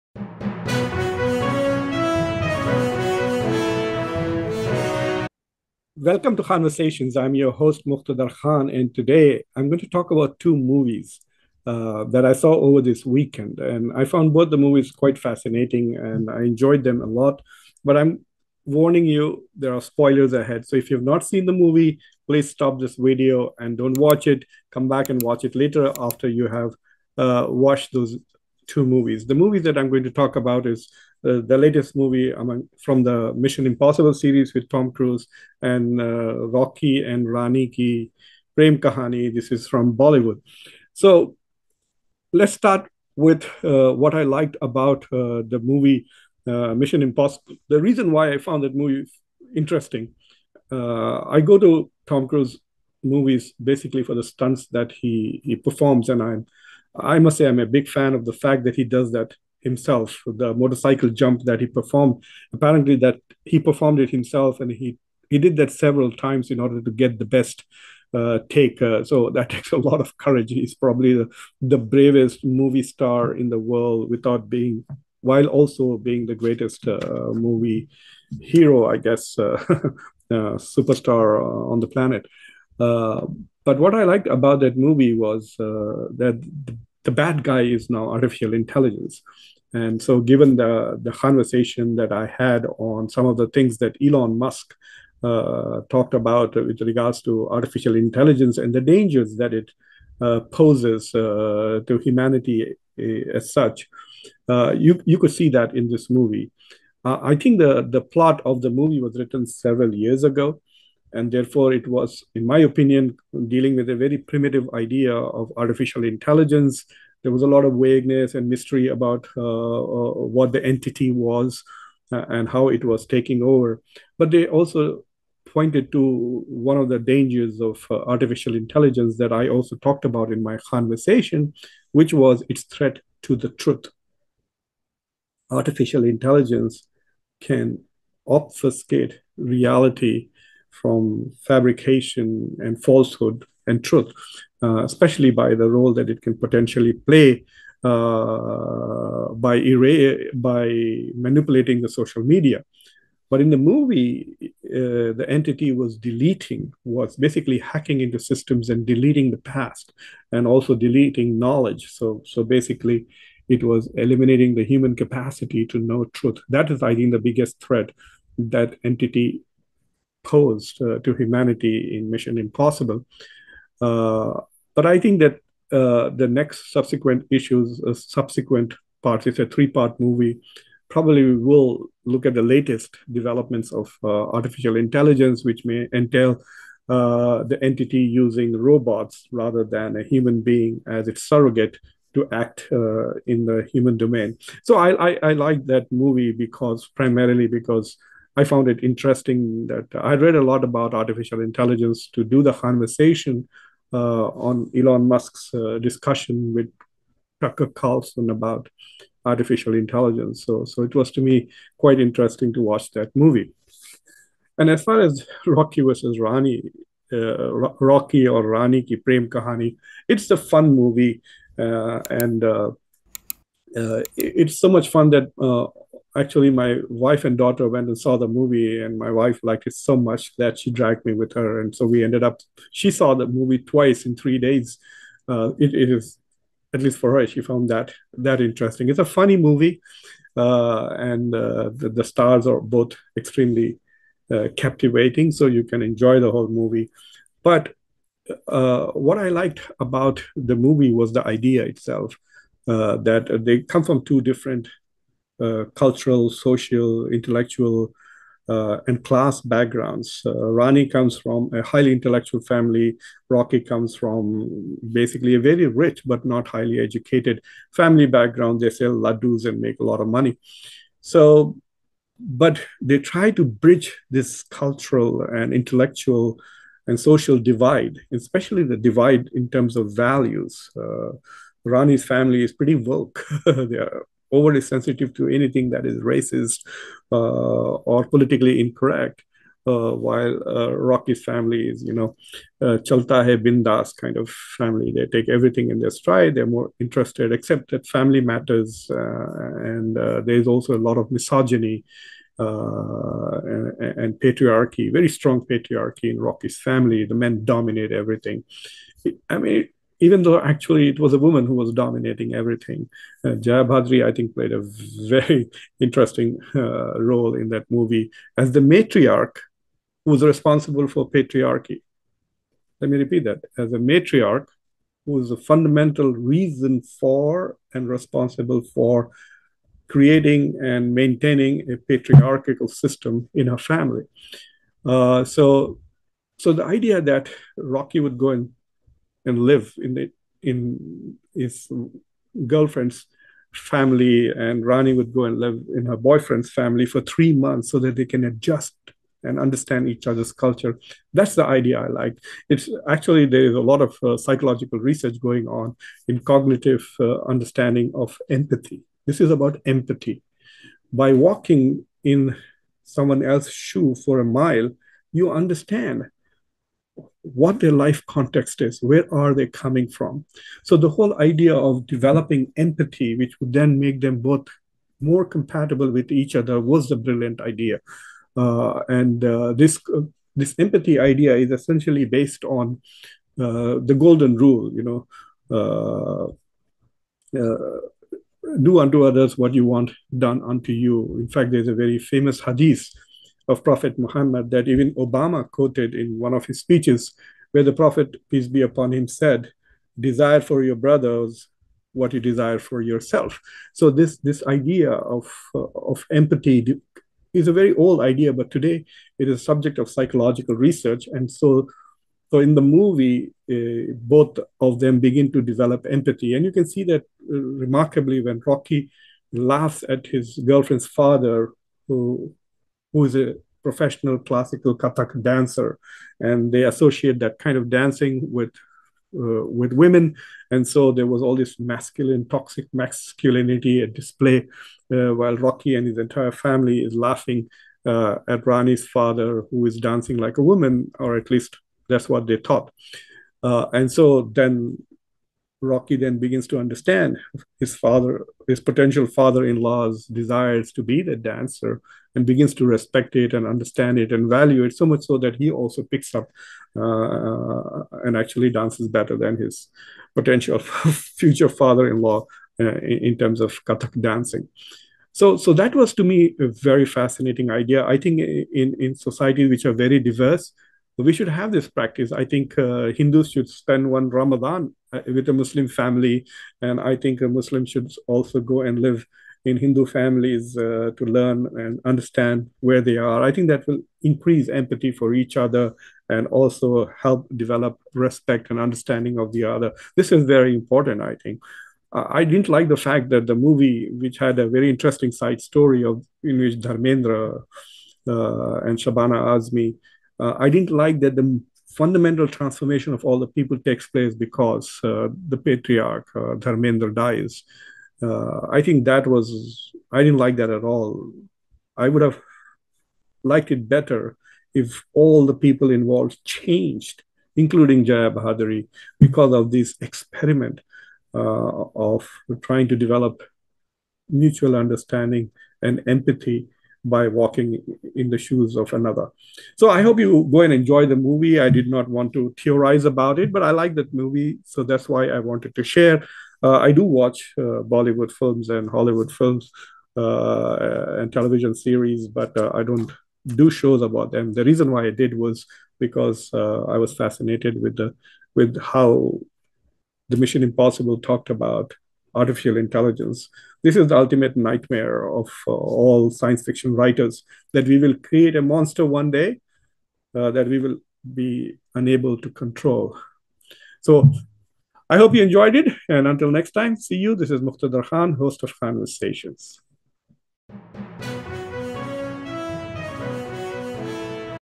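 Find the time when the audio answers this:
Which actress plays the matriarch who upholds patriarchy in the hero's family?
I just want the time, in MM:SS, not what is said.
05:13.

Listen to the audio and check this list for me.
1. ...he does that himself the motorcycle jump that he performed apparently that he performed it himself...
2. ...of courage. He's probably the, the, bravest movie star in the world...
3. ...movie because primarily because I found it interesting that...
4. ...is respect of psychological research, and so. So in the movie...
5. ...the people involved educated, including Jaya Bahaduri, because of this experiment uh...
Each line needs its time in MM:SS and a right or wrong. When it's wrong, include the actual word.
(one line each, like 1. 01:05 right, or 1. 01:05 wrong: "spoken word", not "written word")
1. 00:58 right
2. 01:10 right
3. 03:15 right
4. 06:49 wrong: "subject", not "respect"
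5. 08:35 wrong: "changed", not "educated".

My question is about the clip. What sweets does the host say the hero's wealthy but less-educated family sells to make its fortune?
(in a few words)
laddus.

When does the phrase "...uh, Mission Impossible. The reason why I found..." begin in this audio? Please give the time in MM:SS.
00:46.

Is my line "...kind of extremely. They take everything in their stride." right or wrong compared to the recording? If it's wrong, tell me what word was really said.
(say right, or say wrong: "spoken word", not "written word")
wrong: "family", not "extremely".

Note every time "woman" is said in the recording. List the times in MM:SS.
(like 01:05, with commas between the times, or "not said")
05:11, 07:20.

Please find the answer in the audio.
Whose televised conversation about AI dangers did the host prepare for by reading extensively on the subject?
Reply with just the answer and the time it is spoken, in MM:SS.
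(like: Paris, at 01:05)
Tucker Carlson, at 03:27.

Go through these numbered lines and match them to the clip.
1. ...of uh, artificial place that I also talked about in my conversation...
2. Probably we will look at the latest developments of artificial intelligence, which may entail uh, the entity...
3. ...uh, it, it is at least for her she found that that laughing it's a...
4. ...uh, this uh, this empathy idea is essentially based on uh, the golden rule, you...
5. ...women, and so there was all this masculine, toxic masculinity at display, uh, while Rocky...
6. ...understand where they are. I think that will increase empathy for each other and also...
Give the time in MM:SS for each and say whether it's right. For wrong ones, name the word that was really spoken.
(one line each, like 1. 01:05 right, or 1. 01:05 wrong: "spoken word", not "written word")
1. 02:07 wrong: "intelligence", not "place"
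2. 03:00 right
3. 03:55 wrong: "interesting", not "laughing"
4. 06:19 right
5. 07:09 right
6. 08:01 right.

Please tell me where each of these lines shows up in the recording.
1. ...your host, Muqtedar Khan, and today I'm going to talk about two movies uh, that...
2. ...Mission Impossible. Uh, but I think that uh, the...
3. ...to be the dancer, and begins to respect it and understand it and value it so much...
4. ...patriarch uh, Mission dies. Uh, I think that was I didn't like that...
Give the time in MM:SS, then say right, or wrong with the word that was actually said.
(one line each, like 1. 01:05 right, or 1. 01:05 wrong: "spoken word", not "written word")
1. 00:07 right
2. 02:52 right
3. 07:30 right
4. 08:25 wrong: "Dharmendra", not "Mission".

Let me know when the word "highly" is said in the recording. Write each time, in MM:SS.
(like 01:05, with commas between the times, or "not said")
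04:21, 04:26.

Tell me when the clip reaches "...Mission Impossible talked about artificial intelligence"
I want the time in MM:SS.
09:10.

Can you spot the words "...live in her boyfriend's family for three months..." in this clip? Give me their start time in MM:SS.
05:45.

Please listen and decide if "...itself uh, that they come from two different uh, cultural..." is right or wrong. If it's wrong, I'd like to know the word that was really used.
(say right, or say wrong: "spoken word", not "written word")
right.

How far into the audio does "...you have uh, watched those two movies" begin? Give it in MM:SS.
00:26.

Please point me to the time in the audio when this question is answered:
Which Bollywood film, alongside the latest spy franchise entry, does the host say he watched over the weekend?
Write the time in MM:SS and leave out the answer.
00:36.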